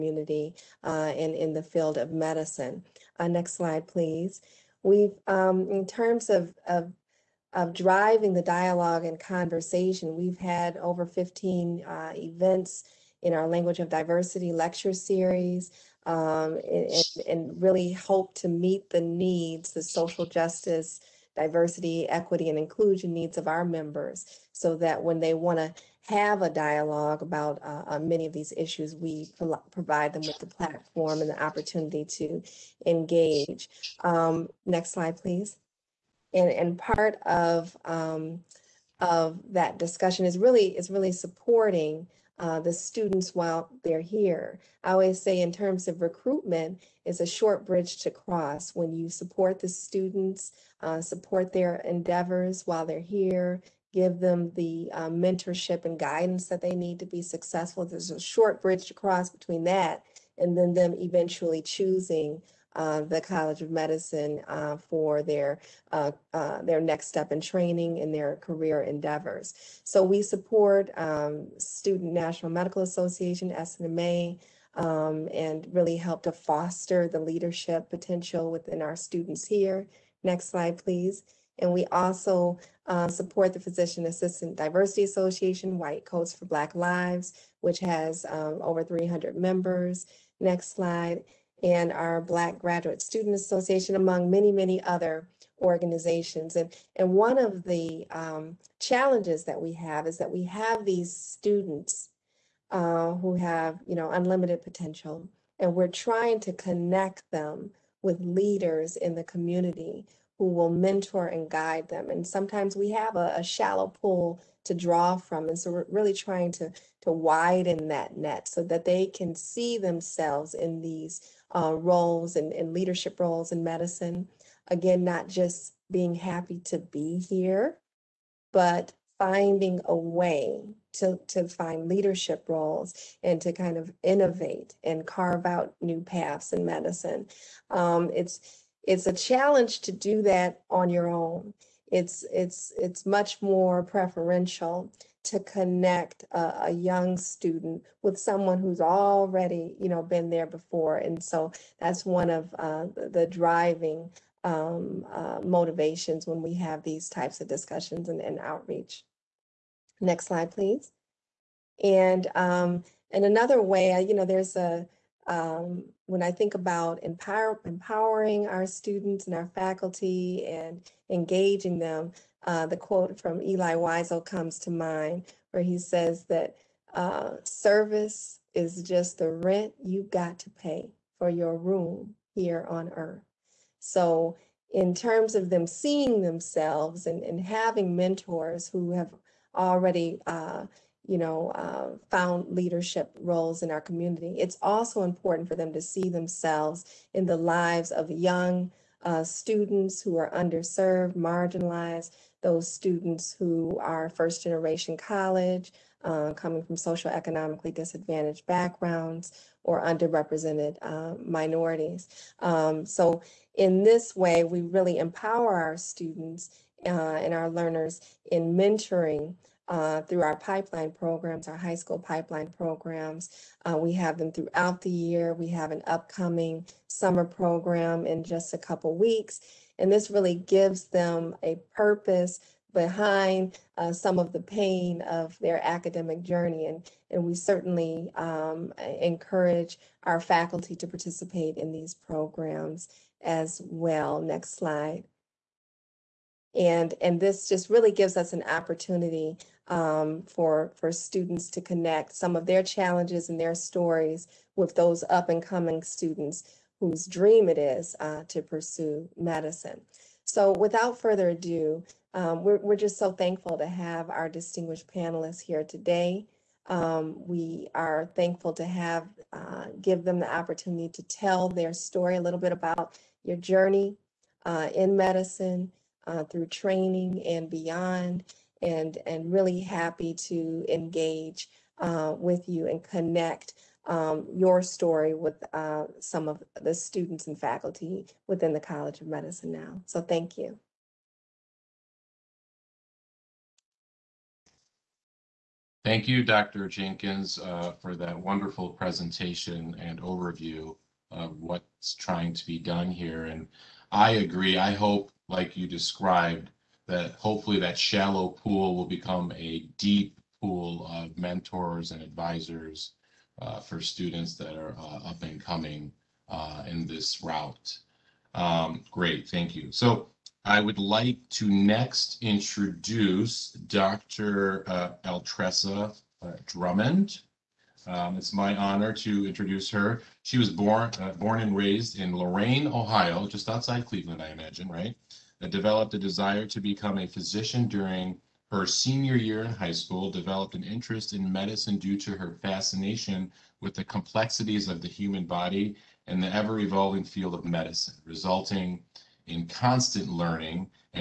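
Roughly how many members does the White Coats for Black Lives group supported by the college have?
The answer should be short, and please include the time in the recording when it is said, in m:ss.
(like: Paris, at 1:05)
over 300, at 1:28.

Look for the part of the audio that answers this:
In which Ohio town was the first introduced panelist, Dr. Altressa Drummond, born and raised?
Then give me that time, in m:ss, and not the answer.
5:32.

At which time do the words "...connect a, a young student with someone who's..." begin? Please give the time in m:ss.
2:25.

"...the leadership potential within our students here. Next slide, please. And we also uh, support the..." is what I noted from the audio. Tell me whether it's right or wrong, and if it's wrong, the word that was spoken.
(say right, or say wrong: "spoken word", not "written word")
right.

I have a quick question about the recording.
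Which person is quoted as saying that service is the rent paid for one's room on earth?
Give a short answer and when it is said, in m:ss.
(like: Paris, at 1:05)
Elie Wiesel, at 2:53.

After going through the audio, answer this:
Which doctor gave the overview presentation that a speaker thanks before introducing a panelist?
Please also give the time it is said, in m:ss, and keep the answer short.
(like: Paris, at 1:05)
Dr. Jenkins, at 4:56.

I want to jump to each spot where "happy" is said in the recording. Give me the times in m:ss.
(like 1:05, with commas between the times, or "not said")
2:06, 4:39.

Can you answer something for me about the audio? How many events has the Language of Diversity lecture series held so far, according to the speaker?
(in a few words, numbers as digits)
over 15.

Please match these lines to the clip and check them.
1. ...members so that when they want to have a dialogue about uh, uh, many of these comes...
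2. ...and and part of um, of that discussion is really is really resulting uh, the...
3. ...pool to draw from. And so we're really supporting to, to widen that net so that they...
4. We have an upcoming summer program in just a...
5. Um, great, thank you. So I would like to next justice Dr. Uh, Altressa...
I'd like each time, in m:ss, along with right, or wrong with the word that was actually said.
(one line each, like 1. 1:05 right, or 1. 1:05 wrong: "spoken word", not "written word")
1. 0:23 wrong: "issues", not "comes"
2. 0:36 wrong: "supporting", not "resulting"
3. 1:54 wrong: "trying", not "supporting"
4. 3:45 right
5. 5:18 wrong: "introduce", not "justice".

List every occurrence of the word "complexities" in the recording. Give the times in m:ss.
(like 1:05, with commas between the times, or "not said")
5:43.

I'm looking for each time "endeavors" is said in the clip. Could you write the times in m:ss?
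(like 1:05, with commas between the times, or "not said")
0:51, 1:08.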